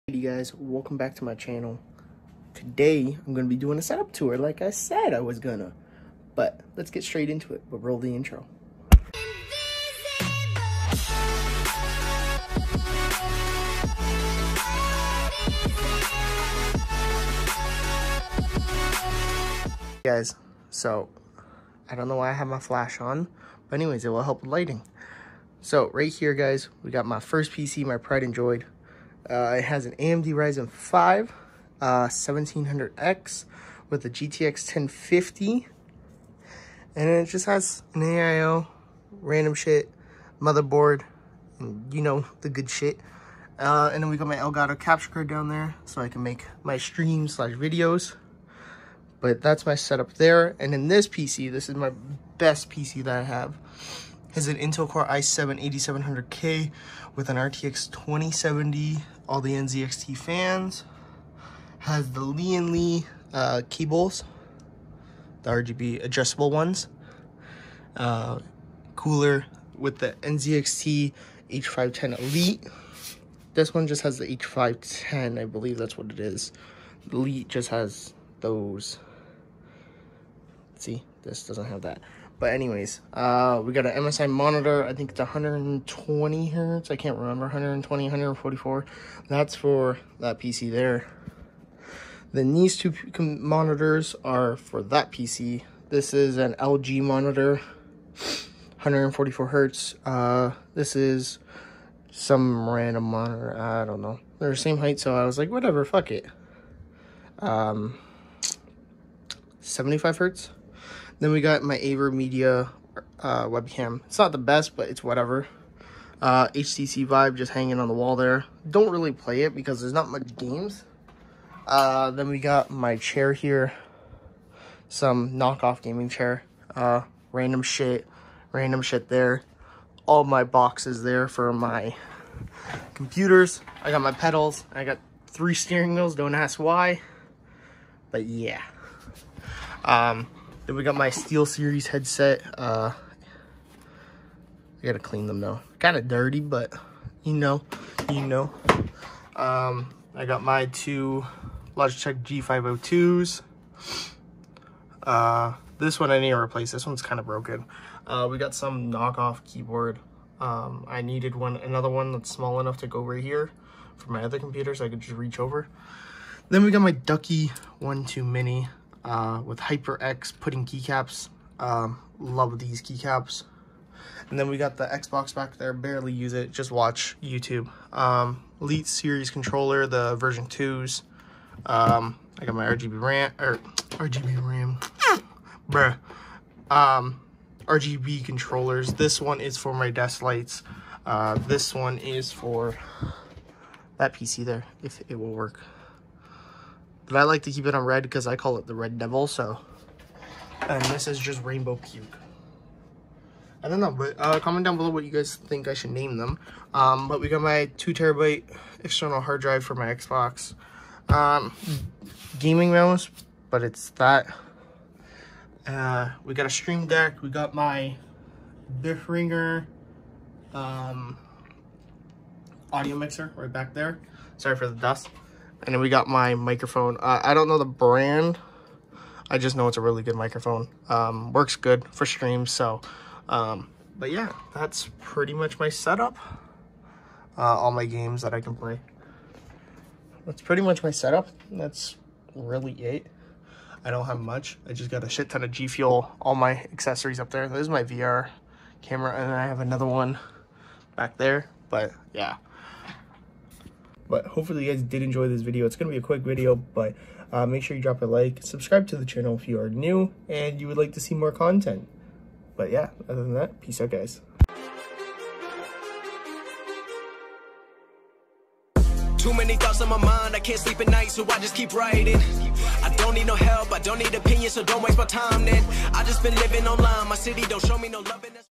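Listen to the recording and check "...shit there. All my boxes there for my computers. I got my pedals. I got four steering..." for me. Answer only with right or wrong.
wrong.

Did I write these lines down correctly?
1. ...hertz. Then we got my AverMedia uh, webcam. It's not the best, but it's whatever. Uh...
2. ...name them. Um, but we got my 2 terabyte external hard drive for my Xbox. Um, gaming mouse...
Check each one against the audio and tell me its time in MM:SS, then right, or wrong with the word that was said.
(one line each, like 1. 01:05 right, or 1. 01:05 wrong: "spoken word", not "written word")
1. 01:50 right
2. 03:25 right.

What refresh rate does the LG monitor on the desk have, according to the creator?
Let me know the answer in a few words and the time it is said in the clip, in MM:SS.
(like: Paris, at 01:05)
144 hertz, at 01:38.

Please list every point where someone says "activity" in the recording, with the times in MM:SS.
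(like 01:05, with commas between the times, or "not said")
not said.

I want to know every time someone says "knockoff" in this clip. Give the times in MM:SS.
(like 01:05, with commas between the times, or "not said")
02:05, 02:38.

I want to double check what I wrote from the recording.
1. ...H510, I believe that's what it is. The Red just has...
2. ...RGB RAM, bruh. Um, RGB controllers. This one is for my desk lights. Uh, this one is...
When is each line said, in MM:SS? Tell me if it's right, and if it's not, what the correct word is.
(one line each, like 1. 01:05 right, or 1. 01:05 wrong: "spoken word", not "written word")
1. 01:14 wrong: "Elite", not "Red"
2. 03:03 right.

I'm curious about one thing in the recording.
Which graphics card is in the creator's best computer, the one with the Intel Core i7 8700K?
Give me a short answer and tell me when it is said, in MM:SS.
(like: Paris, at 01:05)
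RTX 2070, at 00:57.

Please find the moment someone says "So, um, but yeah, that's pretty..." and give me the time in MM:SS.
03:52.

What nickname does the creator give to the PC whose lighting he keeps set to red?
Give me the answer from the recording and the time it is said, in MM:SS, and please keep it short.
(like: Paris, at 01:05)
Red Devil, at 03:18.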